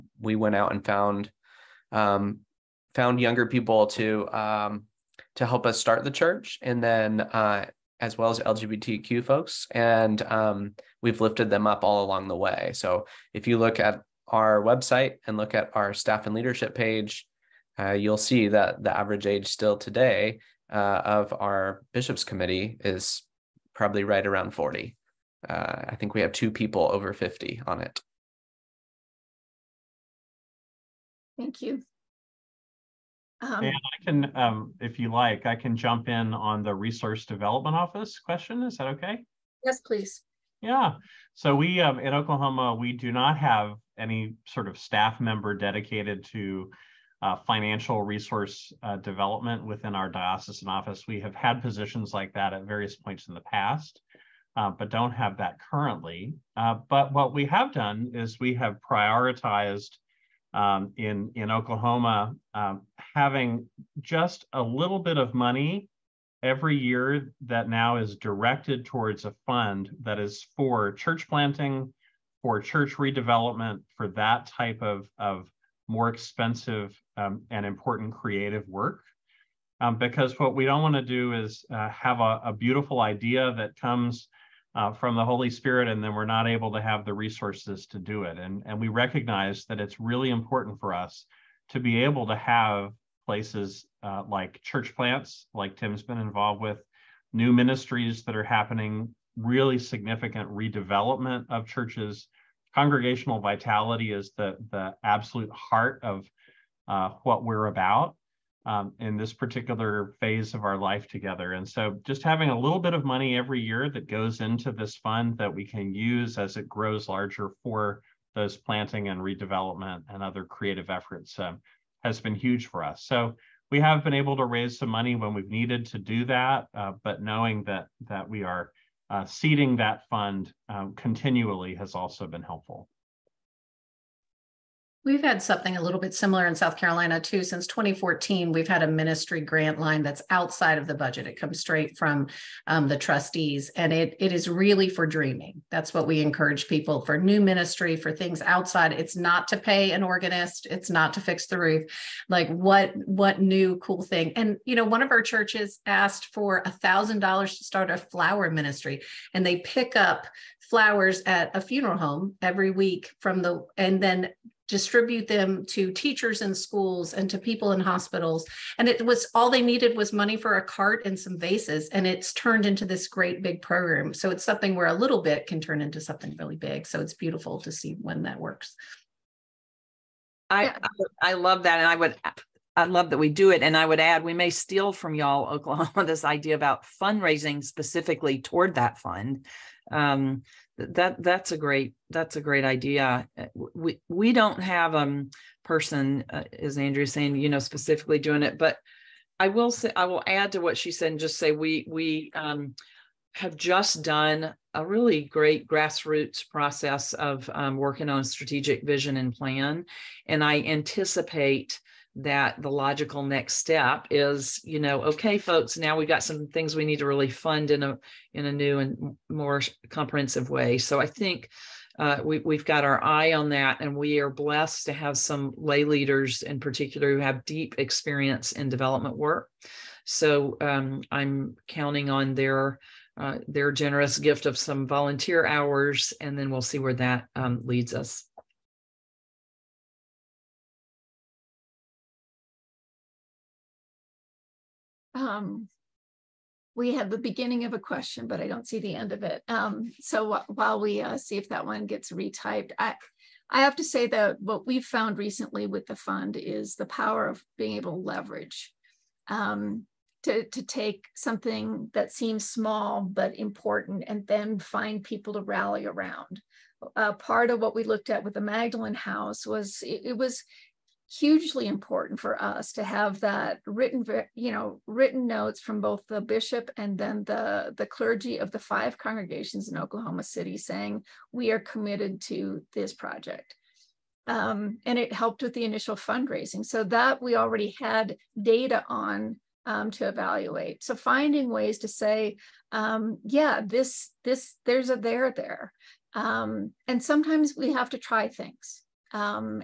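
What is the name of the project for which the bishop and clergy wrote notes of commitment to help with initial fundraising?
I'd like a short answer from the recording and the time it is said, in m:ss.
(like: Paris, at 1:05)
Magdalene House, at 4:28.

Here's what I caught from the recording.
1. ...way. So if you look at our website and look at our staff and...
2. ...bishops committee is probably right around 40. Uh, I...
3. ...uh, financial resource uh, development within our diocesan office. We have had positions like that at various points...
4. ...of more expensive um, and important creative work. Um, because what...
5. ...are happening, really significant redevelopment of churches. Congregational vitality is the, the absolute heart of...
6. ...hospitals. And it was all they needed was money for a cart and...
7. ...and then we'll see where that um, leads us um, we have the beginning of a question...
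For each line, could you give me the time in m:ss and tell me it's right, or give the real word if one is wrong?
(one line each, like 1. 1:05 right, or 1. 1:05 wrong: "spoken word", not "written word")
1. 0:12 right
2. 0:21 right
3. 0:47 right
4. 1:15 right
5. 1:38 right
6. 2:47 right
7. 3:56 right.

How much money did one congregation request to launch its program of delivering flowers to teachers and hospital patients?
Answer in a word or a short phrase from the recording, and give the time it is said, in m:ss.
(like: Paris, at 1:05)
$1,000, at 2:36.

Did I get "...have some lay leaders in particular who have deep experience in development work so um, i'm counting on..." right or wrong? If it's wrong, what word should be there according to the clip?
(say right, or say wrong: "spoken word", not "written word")
right.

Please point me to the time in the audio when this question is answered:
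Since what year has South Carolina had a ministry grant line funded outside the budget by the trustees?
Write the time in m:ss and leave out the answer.
2:17.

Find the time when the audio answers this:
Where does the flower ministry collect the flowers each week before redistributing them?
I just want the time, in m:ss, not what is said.
2:41.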